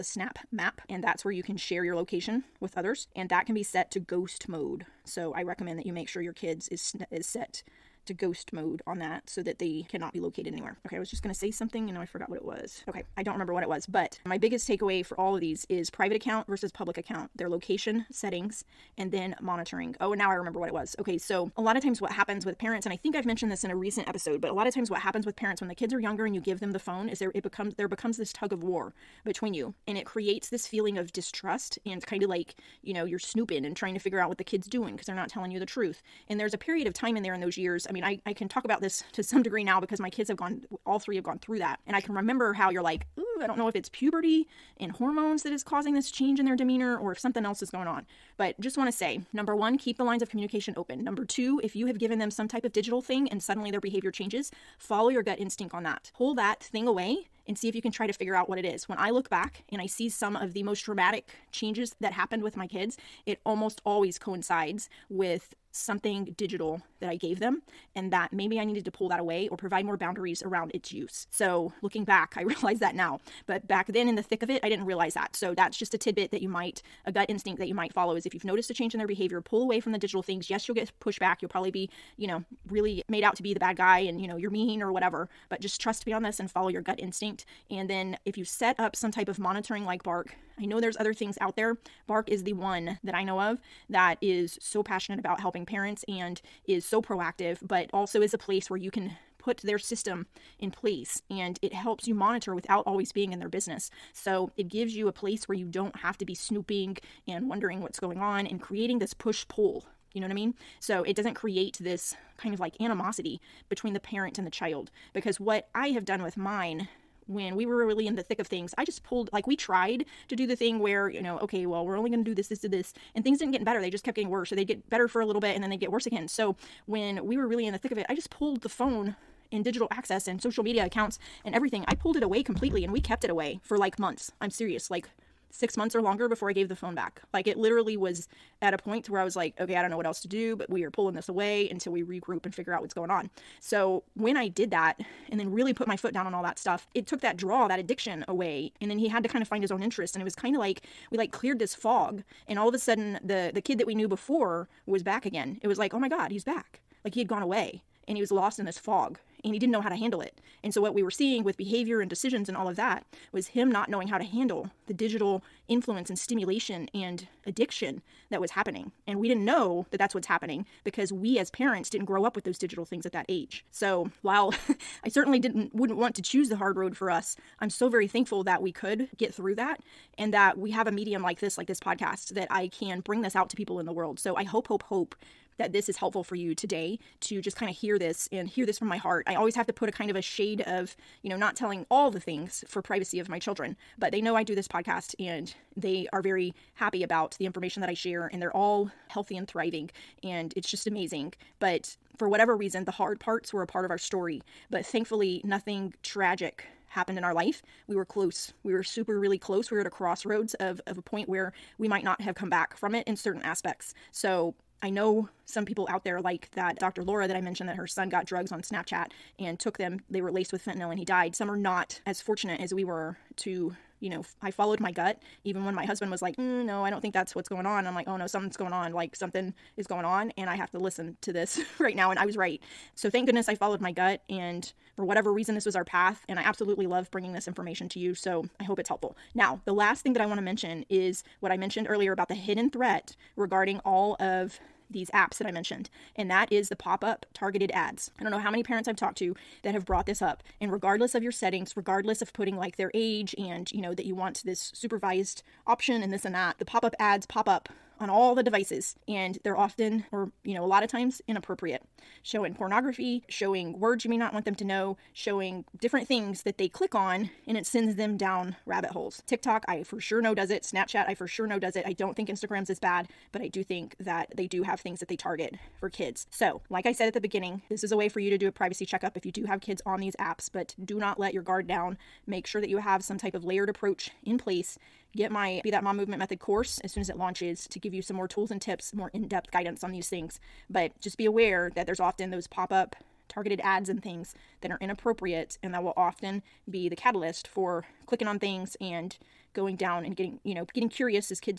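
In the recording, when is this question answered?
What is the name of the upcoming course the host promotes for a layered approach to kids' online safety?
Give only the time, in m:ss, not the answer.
4:45.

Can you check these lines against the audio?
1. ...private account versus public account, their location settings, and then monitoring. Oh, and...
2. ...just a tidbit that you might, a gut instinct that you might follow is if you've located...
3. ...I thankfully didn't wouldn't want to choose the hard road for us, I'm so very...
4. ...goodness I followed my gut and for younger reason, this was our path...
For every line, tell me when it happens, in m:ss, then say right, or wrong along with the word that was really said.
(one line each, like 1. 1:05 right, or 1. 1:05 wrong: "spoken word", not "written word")
1. 0:15 right
2. 1:15 wrong: "noticed", not "located"
3. 2:55 wrong: "certainly", not "thankfully"
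4. 3:53 wrong: "whatever", not "younger".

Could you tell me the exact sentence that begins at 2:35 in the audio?
It was like, oh my God, he's back.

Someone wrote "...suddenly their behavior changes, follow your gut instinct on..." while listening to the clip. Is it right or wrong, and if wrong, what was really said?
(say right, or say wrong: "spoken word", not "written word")
right.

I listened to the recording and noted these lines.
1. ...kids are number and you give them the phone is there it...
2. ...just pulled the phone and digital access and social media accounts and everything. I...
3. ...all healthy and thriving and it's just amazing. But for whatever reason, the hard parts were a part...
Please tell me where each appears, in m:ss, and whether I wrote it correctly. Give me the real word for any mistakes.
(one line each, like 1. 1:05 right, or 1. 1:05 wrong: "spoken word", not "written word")
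1. 0:25 wrong: "younger", not "number"
2. 2:08 right
3. 3:18 right.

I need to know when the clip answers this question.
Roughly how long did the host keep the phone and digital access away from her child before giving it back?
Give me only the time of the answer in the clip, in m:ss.
2:15.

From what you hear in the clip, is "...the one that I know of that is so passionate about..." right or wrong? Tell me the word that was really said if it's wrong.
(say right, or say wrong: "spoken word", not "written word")
right.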